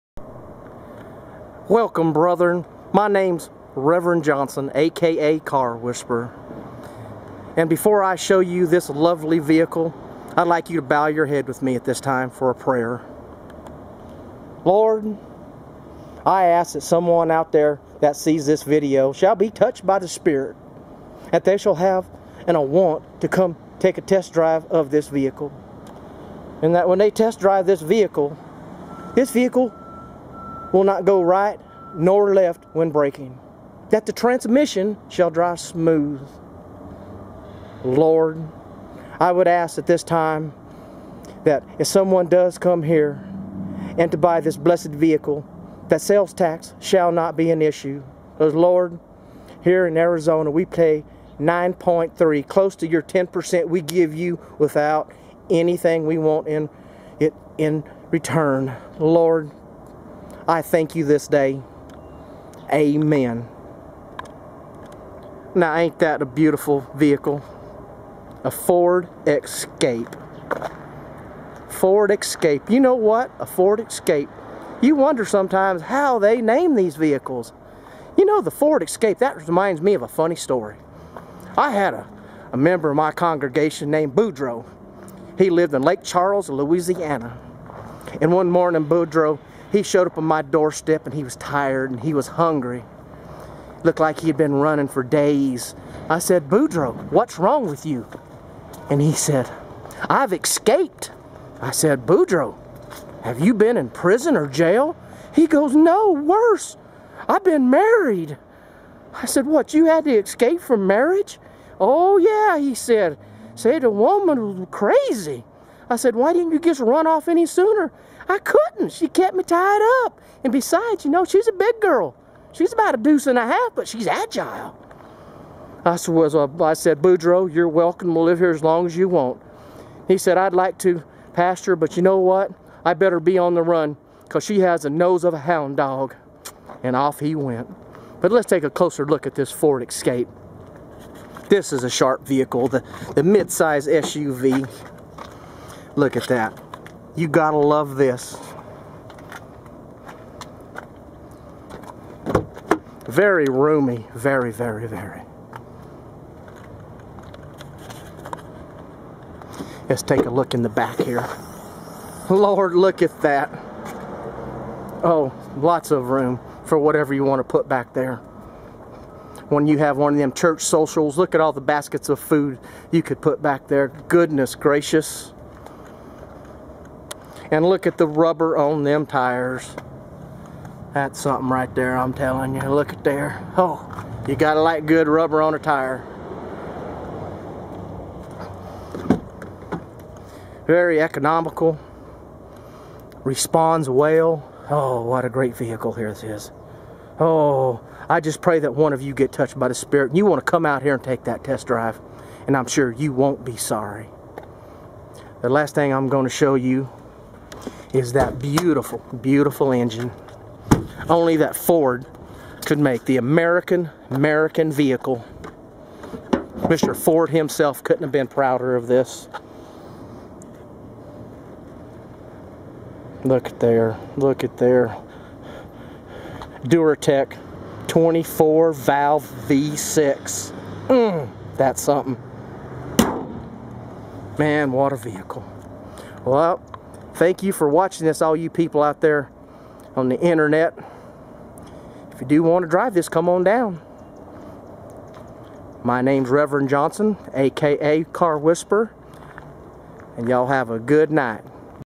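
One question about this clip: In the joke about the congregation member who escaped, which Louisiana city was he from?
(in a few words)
Lake Charles.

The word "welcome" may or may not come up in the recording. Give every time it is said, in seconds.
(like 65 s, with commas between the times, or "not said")
1 s, 127 s.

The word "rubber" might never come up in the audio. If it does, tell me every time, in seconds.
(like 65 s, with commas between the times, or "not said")
178 s, 185 s.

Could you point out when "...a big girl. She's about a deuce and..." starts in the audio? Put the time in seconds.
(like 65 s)
121 s.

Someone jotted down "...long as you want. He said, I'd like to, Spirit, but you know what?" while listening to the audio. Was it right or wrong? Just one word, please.
wrong.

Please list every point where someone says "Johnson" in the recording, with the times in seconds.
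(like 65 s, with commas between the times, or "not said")
4 s, 246 s.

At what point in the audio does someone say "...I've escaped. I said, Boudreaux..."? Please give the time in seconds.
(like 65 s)
100 s.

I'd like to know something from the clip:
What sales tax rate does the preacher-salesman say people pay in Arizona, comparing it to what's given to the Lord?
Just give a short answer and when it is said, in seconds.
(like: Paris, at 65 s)
9.3, at 51 s.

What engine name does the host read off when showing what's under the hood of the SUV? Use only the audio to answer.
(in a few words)
Duratec 24 valve V6.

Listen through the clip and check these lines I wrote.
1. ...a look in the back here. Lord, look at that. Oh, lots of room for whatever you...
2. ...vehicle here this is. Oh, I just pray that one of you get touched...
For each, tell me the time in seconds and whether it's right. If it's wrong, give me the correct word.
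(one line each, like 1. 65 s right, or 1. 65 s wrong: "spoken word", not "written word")
1. 160 s right
2. 195 s right.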